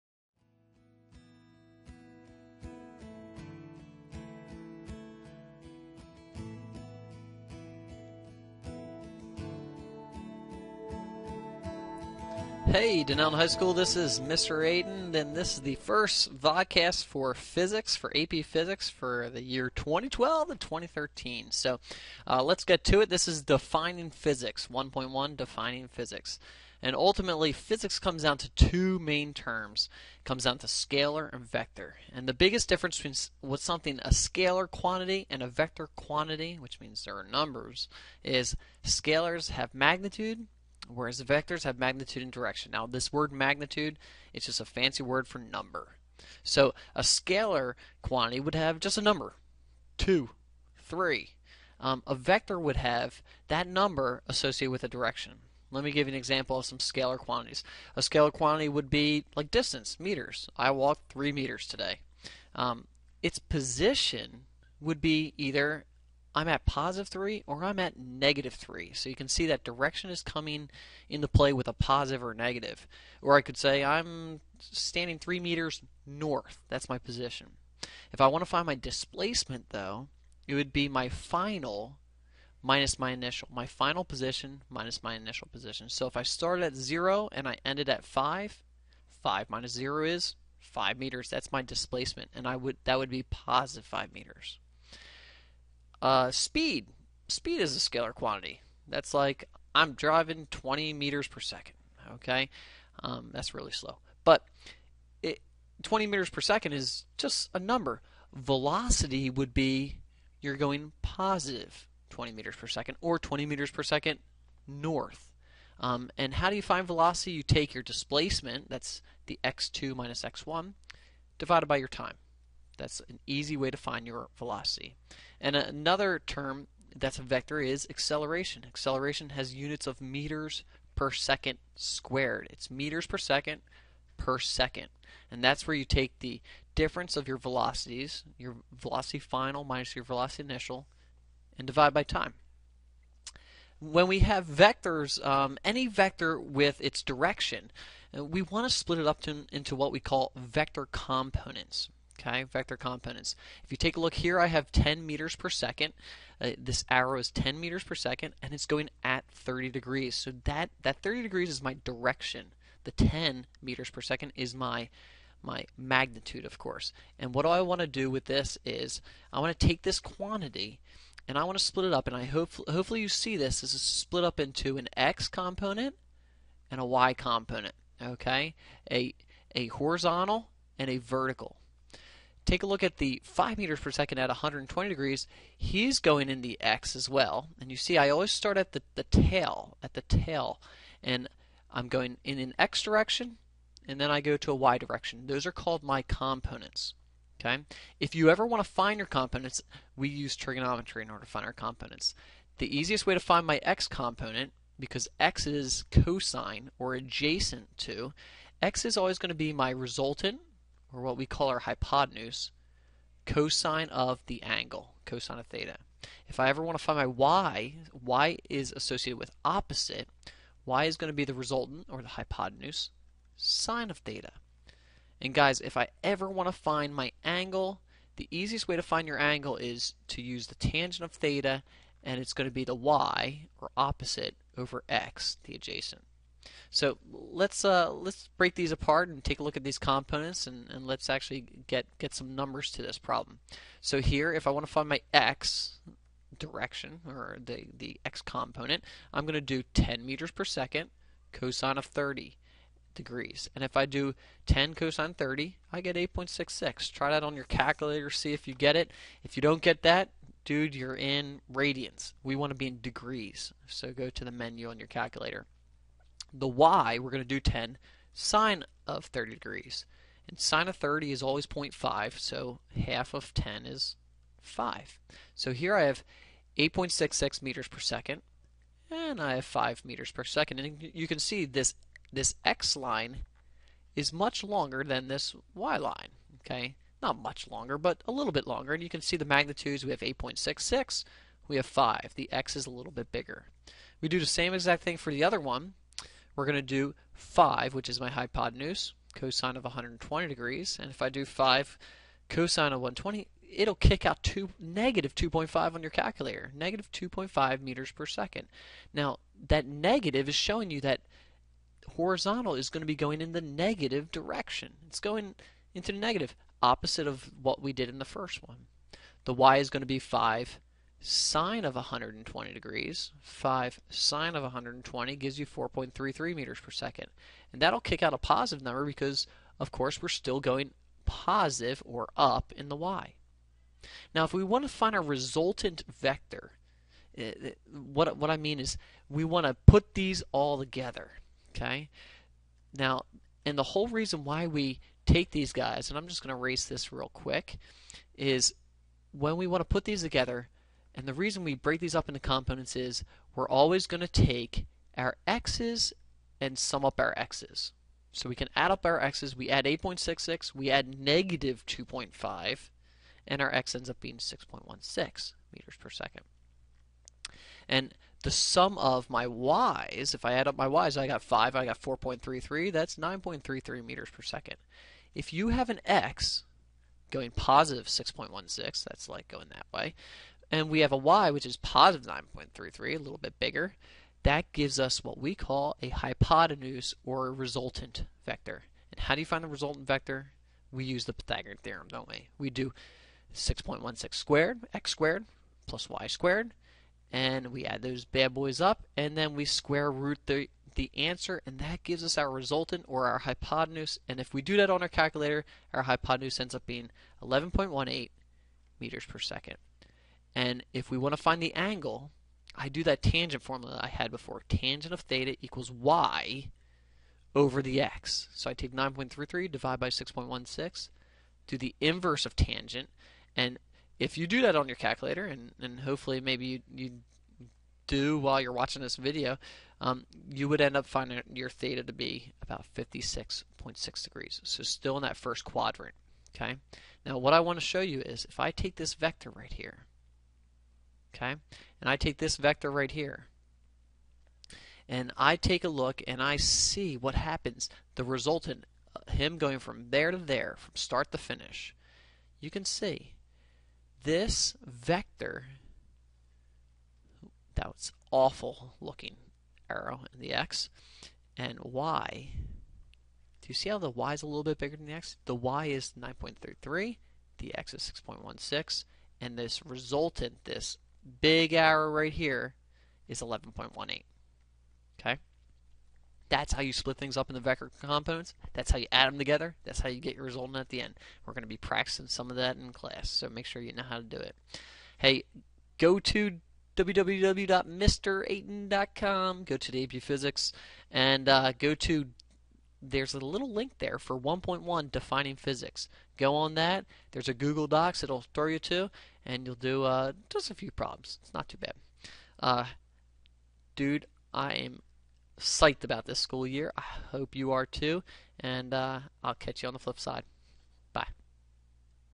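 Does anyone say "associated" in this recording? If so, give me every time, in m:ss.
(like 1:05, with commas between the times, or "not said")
0:54, 3:38.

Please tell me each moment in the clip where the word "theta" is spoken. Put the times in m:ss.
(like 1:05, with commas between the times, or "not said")
3:35, 3:43, 3:51, 6:55, 7:11.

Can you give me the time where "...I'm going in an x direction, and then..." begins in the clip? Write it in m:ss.
3:11.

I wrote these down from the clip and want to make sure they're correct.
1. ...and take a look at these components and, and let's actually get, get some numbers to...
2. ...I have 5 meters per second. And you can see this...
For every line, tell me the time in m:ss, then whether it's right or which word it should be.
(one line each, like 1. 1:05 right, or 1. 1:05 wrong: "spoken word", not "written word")
1. 3:59 right
2. 4:39 right.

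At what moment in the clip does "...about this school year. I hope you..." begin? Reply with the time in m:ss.
8:25.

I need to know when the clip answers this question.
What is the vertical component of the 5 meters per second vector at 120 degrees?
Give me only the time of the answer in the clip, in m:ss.
5:25.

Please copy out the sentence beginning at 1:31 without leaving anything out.
That's my displacement and I would that would be positive 5 meters.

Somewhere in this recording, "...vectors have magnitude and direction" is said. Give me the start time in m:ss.
0:41.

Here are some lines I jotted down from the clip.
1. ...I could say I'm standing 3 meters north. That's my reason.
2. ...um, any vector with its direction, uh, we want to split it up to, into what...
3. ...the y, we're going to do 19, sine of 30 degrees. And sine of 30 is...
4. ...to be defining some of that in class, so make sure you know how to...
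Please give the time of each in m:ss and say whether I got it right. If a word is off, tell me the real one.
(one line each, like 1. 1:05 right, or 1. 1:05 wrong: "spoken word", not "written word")
1. 1:13 wrong: "position", not "reason"
2. 2:25 right
3. 4:26 wrong: "10", not "19"
4. 8:01 wrong: "practicing", not "defining".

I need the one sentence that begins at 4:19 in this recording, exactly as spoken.
If you don't get that, dude, you're in radians.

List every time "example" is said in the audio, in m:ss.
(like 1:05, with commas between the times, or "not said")
0:56.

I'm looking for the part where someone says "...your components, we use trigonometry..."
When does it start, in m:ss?
3:18.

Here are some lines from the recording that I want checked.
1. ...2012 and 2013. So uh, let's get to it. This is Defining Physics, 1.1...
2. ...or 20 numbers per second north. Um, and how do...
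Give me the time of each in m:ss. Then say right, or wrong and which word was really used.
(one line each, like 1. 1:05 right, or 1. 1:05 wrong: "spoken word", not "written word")
1. 0:19 right
2. 1:53 wrong: "meters", not "numbers".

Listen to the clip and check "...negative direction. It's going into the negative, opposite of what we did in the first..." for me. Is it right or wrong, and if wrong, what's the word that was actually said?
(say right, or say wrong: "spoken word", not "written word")
right.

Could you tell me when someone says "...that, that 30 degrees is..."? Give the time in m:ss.
2:40.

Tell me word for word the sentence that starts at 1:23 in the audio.
My final position minus my initial position.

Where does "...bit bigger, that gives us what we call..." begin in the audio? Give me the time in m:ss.
6:23.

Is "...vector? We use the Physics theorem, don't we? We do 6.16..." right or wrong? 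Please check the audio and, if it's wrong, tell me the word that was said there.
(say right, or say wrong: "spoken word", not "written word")
wrong: "Pythagorean", not "Physics".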